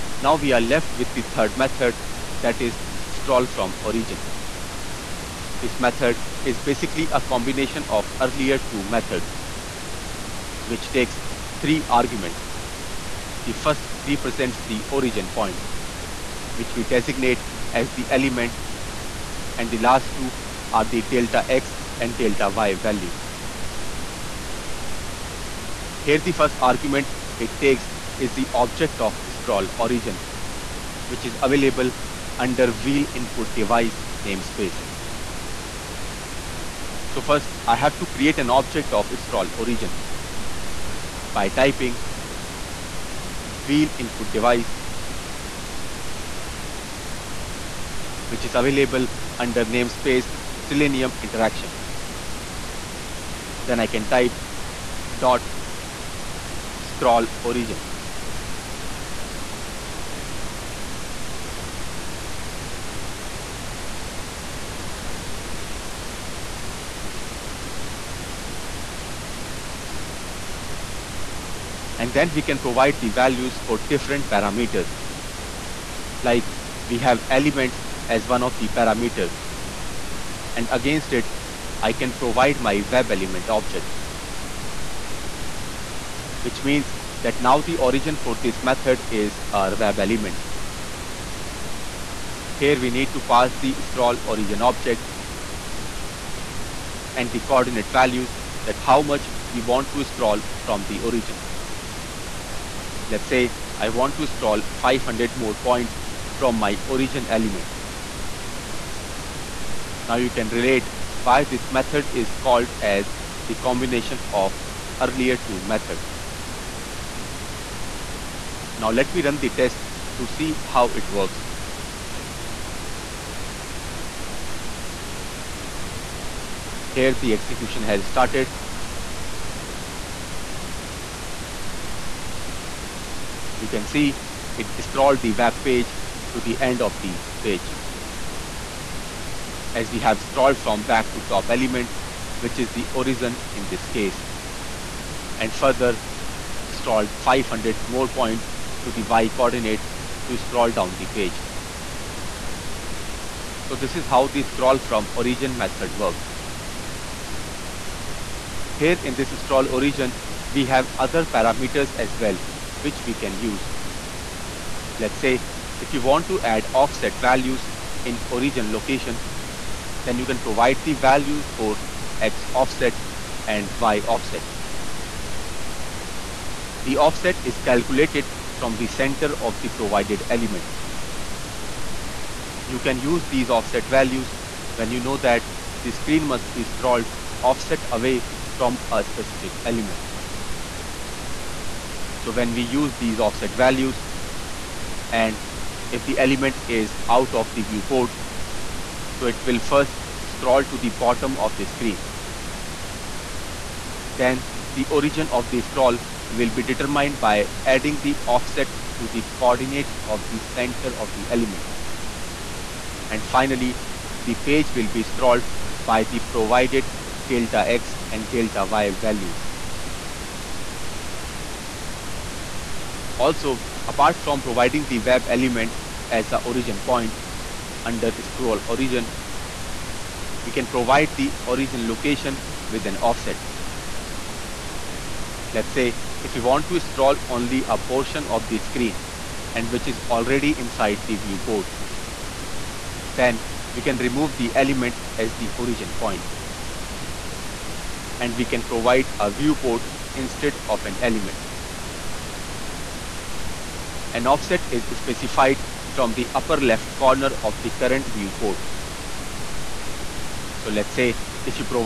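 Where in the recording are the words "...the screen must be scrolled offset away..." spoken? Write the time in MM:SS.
03:05.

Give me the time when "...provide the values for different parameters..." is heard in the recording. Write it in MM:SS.
01:12.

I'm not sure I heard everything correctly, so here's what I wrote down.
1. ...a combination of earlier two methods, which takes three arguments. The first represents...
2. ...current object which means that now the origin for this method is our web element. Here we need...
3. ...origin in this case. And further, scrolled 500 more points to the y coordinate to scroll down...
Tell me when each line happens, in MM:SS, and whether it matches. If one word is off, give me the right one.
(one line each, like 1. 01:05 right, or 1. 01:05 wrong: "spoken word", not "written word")
1. 00:07 right
2. 01:23 wrong: "element", not "current"
3. 02:22 right.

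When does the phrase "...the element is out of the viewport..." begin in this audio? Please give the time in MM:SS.
03:16.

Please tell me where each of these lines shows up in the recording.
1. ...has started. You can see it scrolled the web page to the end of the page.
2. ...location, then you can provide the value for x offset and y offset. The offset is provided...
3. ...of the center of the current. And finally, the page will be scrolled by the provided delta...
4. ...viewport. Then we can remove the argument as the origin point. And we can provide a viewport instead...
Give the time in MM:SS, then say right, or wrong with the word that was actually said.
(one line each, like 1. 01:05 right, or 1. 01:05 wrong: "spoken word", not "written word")
1. 02:07 right
2. 02:48 wrong: "calculated", not "provided"
3. 03:30 wrong: "element", not "current"
4. 04:01 wrong: "element", not "argument".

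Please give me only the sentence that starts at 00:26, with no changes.
Here the first argument it takes is the object of scroll origin, which is available under wheel input device namespace.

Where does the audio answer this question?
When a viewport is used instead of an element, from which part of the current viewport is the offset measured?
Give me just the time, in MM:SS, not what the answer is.
04:16.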